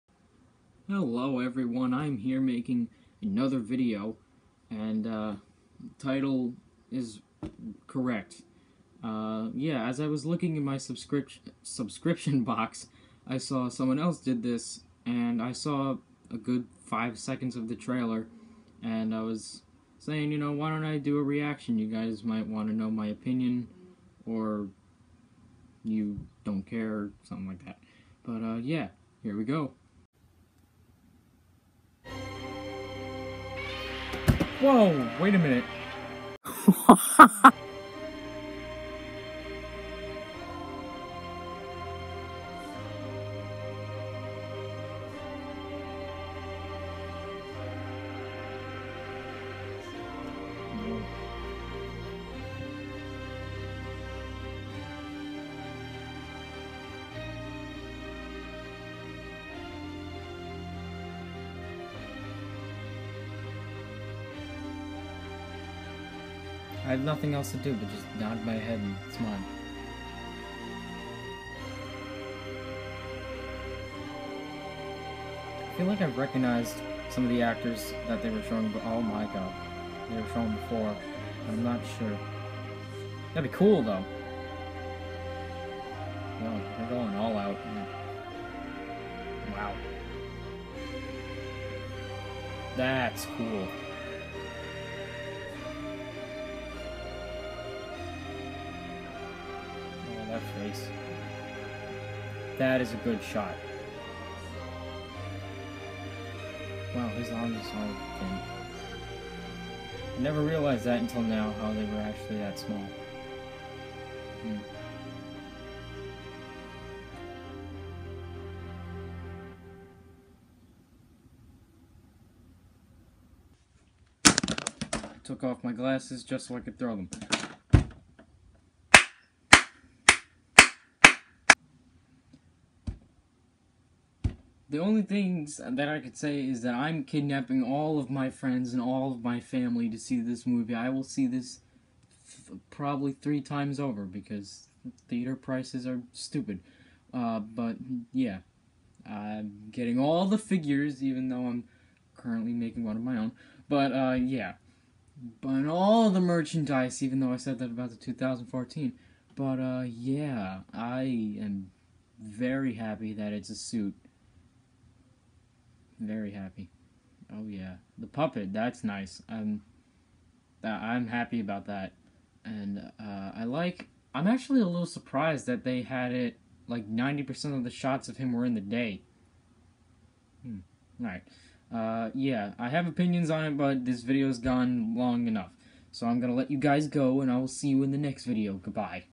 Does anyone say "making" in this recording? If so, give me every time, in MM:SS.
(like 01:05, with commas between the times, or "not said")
00:02, 02:32.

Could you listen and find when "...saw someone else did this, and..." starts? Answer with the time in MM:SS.
00:13.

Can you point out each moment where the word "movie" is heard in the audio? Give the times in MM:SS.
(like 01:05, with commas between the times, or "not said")
02:20.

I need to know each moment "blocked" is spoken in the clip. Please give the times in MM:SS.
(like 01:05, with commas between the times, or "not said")
not said.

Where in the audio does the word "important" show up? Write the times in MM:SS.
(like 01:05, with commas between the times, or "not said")
not said.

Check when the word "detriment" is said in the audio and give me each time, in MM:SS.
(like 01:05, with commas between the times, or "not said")
not said.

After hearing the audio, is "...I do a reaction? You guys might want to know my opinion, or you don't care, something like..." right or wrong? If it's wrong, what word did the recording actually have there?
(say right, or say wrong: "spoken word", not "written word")
right.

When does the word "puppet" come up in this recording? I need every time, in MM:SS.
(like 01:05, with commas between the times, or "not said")
02:48.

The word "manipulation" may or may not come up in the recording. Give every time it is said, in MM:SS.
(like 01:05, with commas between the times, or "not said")
not said.